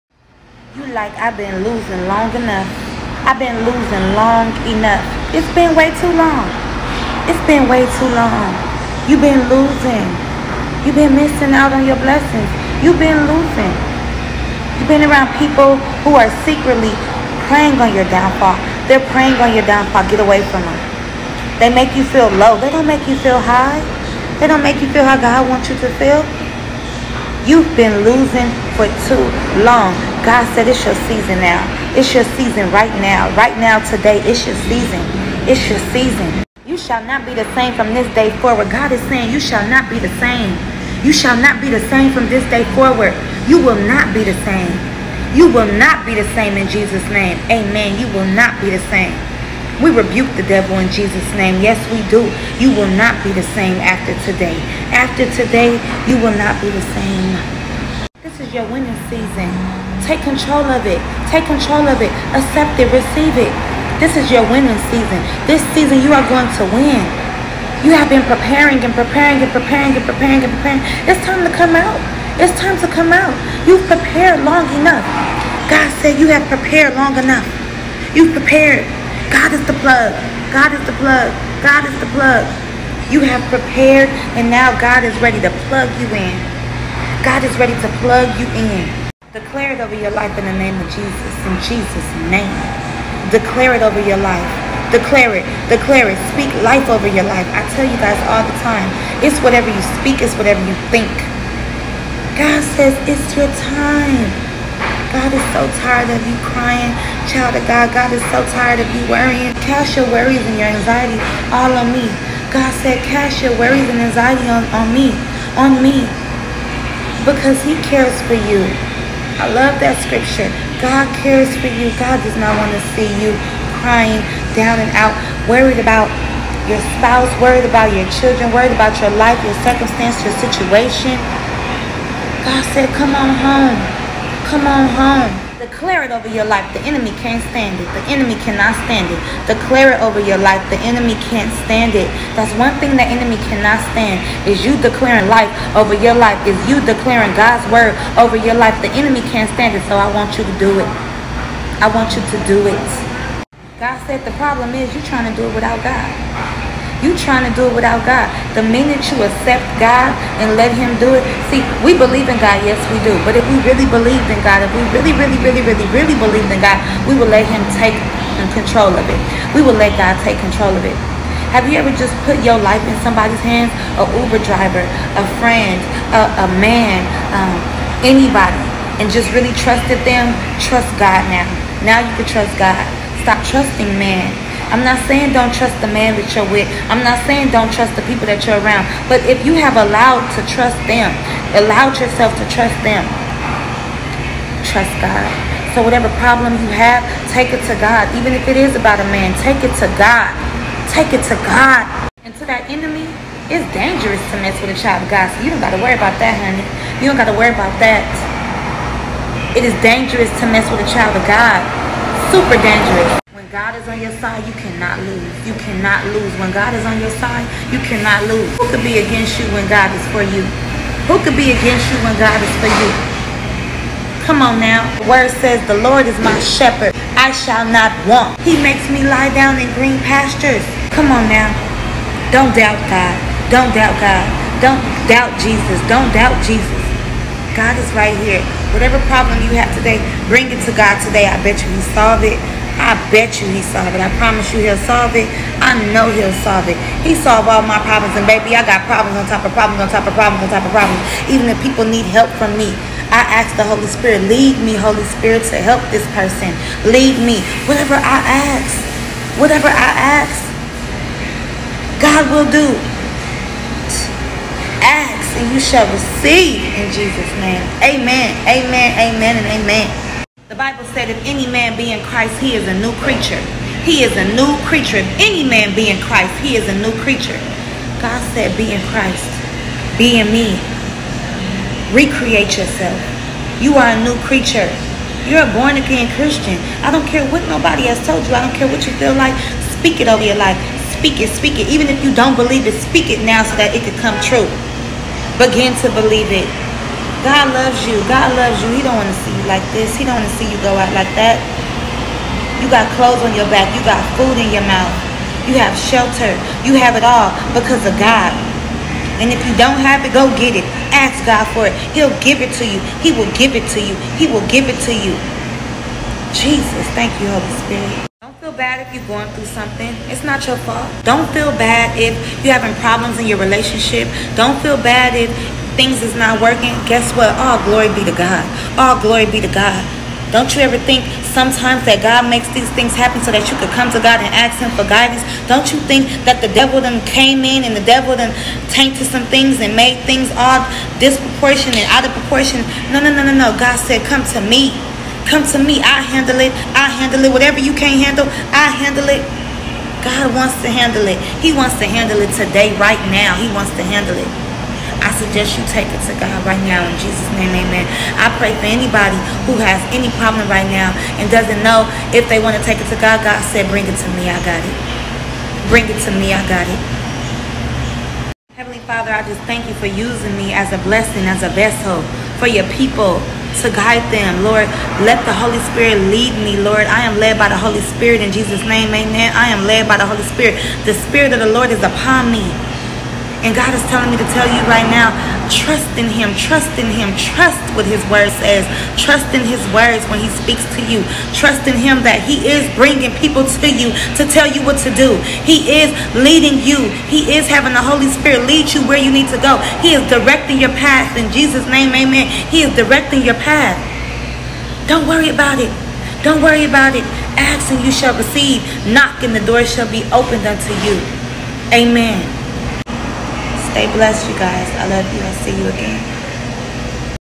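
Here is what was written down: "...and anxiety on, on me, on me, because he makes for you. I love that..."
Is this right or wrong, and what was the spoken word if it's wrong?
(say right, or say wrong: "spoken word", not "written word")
wrong: "cares", not "makes".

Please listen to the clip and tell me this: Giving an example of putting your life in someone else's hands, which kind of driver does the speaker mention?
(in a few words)
Uber driver.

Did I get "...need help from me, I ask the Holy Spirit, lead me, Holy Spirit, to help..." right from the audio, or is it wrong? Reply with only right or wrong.
right.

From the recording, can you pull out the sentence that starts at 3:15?
So whatever problem you have, take it to God.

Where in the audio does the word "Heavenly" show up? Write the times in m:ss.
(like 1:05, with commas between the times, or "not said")
6:08.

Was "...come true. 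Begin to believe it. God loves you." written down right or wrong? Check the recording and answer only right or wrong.
right.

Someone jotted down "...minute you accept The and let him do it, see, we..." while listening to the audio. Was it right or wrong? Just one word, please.
wrong.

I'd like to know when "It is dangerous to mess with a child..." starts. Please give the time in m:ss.
3:29.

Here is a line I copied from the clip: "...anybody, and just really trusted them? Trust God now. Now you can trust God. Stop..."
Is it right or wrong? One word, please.
right.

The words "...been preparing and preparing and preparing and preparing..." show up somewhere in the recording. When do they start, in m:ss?
1:08.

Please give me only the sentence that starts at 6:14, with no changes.
Lord, let the Holy Spirit lead me, Lord.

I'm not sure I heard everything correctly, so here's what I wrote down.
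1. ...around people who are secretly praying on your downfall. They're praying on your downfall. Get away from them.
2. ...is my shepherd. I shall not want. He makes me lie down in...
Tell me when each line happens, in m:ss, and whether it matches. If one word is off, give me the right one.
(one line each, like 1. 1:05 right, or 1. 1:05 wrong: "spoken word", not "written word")
1. 0:15 right
2. 3:46 right.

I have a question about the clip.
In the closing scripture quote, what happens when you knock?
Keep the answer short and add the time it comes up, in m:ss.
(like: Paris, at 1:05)
The door shall be opened, at 6:49.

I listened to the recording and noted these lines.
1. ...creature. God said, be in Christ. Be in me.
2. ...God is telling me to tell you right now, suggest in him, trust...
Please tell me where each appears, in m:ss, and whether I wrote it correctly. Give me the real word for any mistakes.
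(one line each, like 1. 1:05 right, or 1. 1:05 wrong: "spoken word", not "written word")
1. 4:36 right
2. 6:23 wrong: "trust", not "suggest".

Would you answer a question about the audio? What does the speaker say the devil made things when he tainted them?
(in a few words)
Disproportionate.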